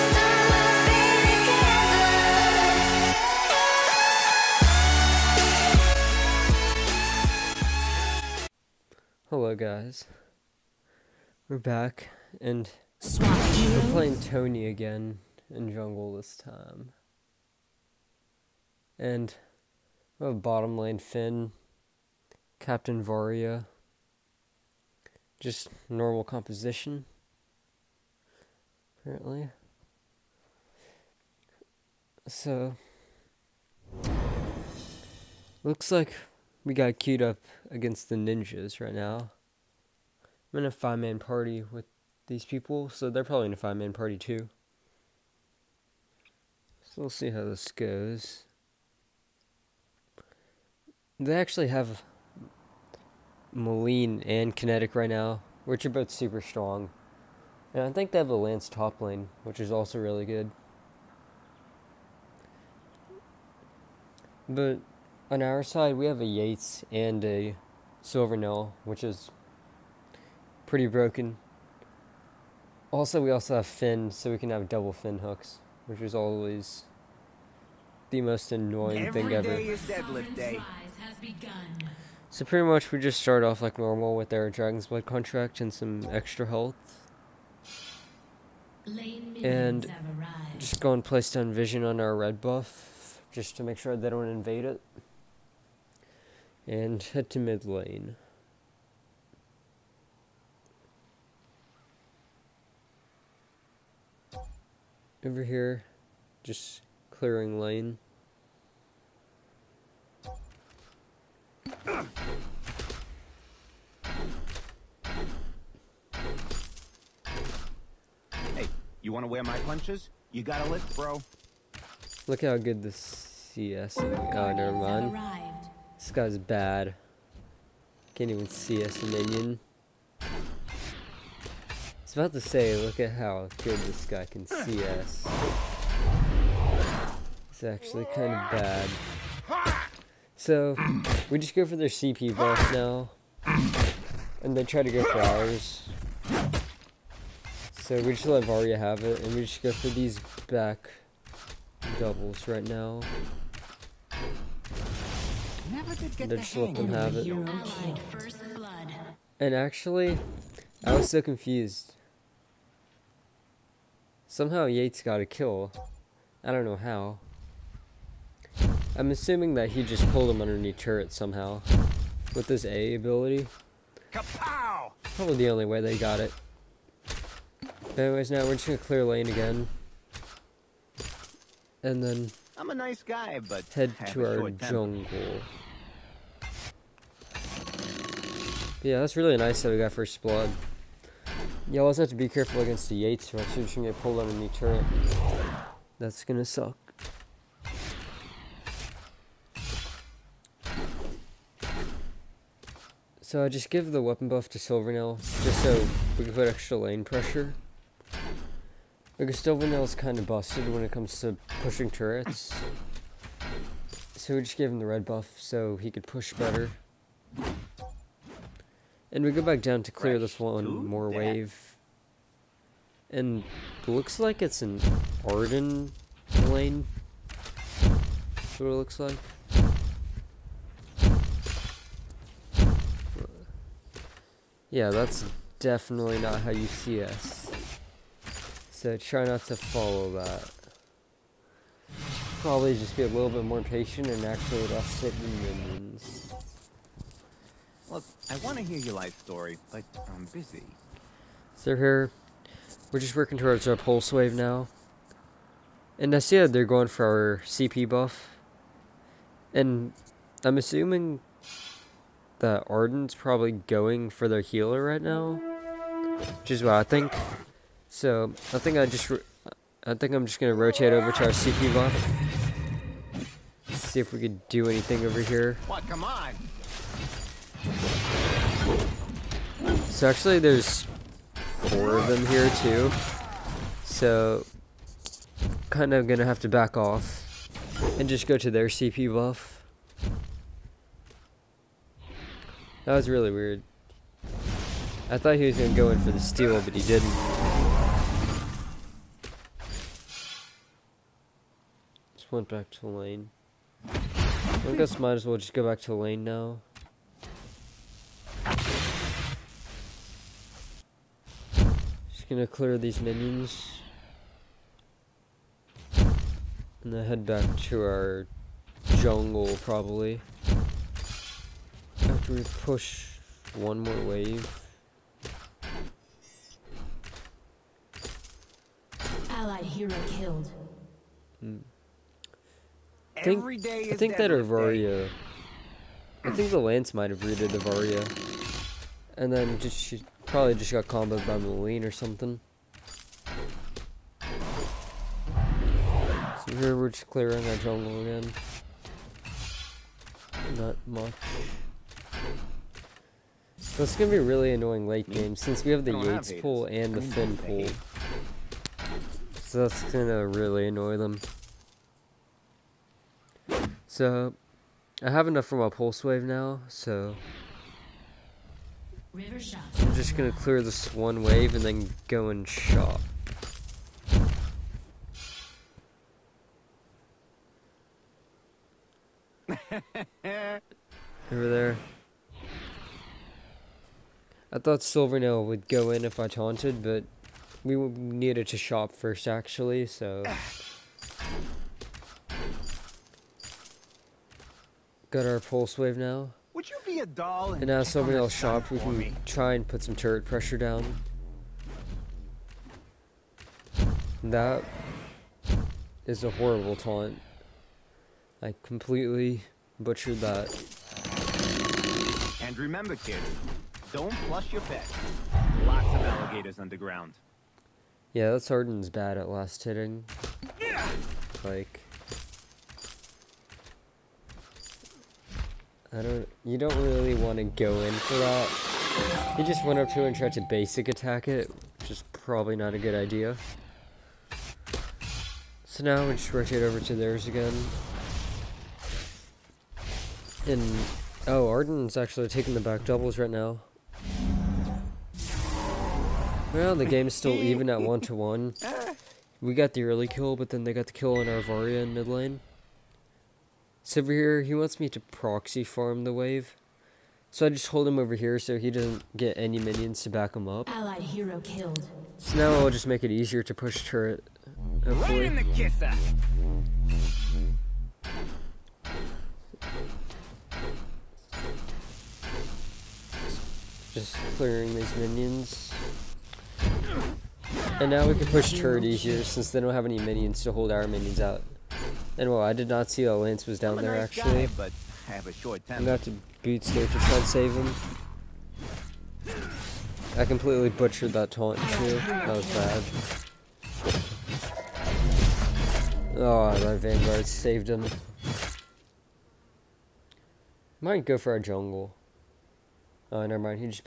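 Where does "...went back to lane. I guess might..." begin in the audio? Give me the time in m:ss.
5:02.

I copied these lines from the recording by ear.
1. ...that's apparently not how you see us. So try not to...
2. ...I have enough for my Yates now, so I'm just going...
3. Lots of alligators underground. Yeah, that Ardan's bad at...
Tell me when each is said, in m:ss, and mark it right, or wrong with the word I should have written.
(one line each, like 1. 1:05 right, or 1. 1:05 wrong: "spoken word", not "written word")
1. 3:54 wrong: "definitely", not "apparently"
2. 6:05 wrong: "Pulseweave", not "Yates"
3. 6:55 right.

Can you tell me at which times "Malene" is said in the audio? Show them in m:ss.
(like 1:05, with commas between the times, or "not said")
0:53, 5:41.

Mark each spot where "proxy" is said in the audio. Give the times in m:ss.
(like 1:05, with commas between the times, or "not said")
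7:35.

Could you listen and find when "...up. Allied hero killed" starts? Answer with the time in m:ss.
7:40.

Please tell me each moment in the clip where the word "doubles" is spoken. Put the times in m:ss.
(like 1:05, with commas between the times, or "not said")
1:14, 2:31, 7:22.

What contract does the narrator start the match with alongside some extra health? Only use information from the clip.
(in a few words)
Dragon's Blood.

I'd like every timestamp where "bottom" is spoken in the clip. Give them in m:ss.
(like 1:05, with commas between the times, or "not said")
0:20.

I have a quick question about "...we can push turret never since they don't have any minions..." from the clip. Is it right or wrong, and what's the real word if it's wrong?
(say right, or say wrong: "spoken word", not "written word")
wrong: "easier", not "never".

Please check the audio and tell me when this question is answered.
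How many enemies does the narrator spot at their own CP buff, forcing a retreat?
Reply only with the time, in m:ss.
4:41.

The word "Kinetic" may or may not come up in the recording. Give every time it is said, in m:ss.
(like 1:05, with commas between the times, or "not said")
0:54.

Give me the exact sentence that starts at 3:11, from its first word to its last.
You always have to be careful against the Yates, we you're just gonna get pulled underneath turret.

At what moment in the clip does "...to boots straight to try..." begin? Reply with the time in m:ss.
8:06.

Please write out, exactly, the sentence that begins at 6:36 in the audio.
Would you be a doll and, and now Silvernail shopped, we can me.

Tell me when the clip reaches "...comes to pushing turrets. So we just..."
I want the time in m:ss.
3:30.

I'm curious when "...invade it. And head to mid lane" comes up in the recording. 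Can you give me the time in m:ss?
1:34.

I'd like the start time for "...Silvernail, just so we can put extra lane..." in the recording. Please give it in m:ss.
3:24.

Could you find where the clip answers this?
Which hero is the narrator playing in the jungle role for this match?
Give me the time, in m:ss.
0:14.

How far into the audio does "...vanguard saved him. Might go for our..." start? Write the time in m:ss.
8:16.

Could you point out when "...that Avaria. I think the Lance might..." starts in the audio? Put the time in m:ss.
5:34.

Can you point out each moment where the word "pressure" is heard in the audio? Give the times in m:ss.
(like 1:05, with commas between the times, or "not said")
3:27, 6:40.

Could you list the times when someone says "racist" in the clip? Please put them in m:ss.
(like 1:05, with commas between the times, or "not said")
not said.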